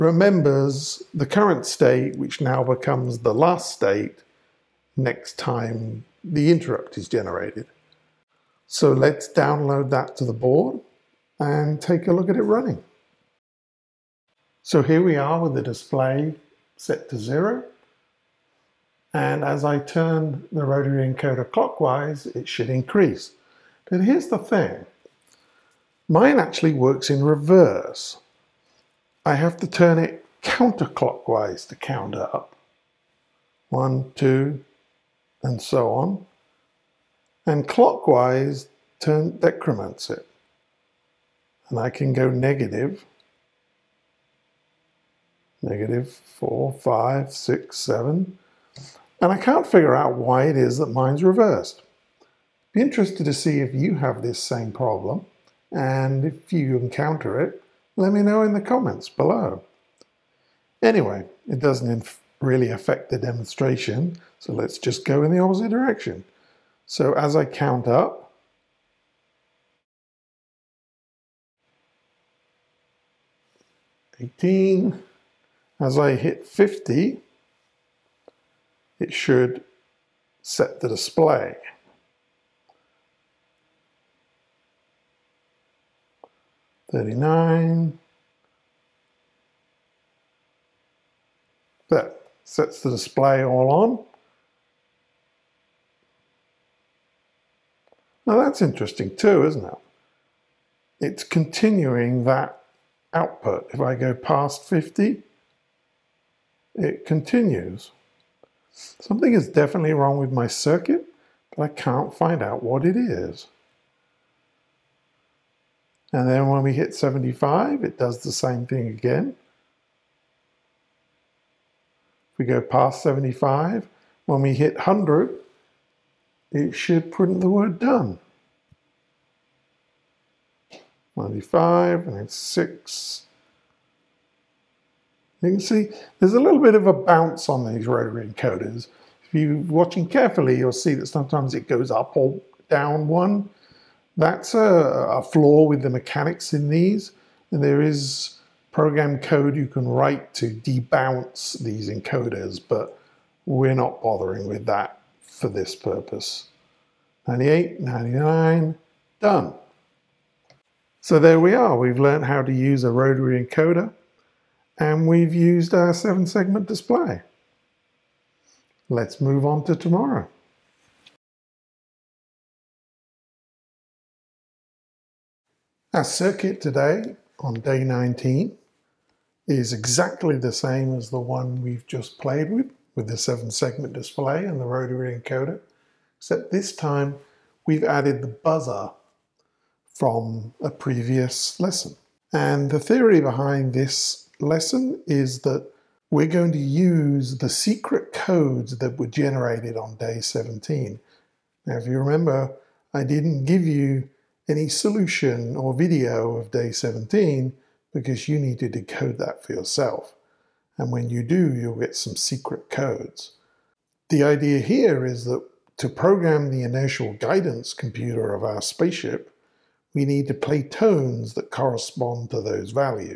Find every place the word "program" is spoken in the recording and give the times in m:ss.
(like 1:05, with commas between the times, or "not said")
2:28, 3:35.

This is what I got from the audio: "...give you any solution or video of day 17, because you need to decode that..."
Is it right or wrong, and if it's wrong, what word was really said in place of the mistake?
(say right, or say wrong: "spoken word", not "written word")
right.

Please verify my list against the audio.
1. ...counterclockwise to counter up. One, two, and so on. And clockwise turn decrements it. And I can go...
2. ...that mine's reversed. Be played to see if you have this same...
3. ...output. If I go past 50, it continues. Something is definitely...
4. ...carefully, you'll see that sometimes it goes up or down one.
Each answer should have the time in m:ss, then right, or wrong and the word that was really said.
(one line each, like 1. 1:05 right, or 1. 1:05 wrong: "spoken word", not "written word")
1. 0:30 right
2. 0:50 wrong: "interested", not "played"
3. 1:43 right
4. 2:20 right.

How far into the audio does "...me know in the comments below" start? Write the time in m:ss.
0:58.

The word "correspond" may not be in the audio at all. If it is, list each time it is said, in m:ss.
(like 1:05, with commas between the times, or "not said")
3:41.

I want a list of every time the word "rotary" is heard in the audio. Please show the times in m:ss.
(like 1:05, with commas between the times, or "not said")
0:20, 2:17, 2:42, 3:04.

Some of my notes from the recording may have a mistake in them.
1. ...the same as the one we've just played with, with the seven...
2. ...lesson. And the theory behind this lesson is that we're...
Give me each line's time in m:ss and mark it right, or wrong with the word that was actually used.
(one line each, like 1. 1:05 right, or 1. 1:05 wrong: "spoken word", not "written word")
1. 3:00 right
2. 3:11 right.